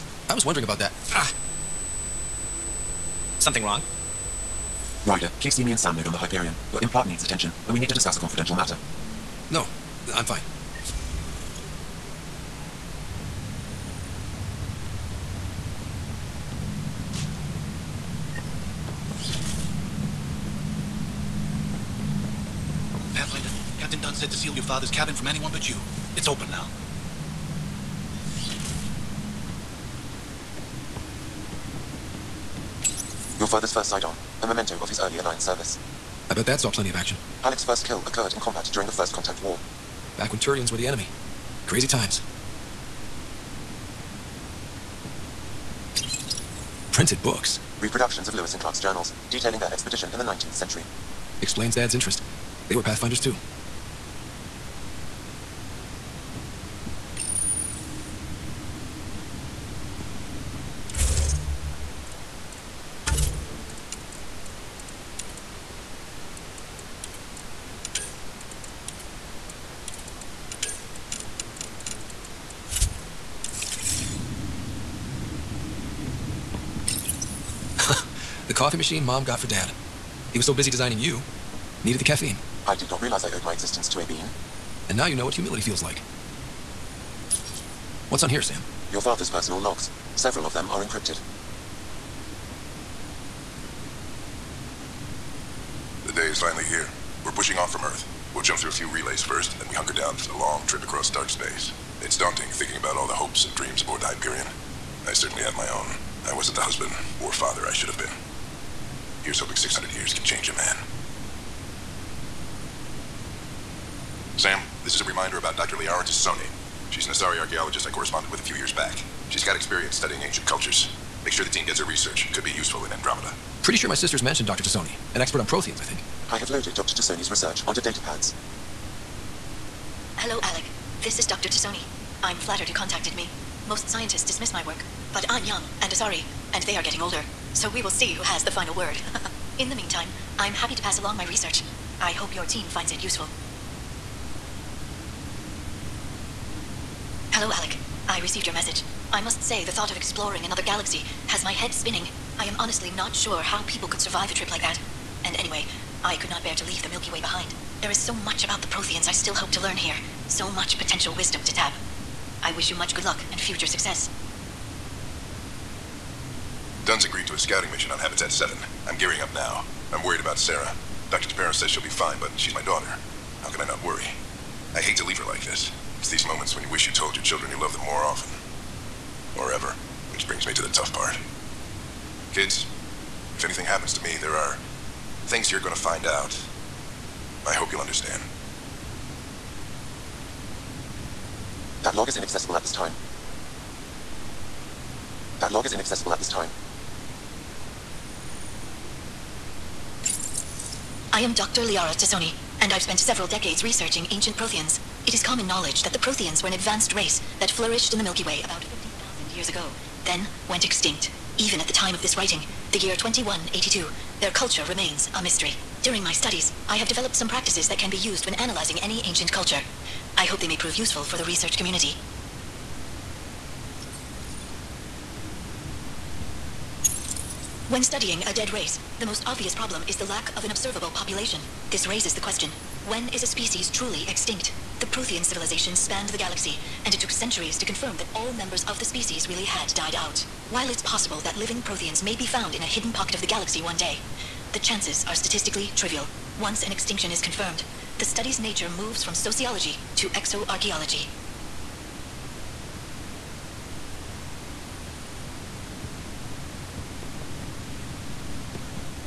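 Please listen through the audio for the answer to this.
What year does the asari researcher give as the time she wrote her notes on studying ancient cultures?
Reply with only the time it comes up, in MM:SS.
03:32.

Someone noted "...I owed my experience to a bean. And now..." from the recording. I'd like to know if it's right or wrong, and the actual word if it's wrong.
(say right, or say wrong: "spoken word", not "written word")
wrong: "existence", not "experience".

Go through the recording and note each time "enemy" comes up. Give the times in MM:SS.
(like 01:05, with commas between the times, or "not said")
00:40.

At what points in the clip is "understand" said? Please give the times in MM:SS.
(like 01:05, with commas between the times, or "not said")
03:07.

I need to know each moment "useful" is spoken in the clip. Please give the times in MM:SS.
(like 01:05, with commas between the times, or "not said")
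02:02, 02:23, 03:40.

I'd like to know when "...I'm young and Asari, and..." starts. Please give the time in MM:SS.
02:15.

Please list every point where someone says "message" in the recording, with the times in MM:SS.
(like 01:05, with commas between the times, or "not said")
02:28.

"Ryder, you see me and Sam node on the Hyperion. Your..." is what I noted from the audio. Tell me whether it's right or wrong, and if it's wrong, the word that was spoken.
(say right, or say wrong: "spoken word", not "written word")
right.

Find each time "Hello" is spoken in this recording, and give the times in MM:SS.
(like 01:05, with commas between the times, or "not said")
02:10, 02:27.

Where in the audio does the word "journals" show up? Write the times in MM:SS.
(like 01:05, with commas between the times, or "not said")
00:48.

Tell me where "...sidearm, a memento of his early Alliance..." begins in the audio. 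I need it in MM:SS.
00:33.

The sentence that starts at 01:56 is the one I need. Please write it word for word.
She's an Asari archaeologist I corresponded with a few years back.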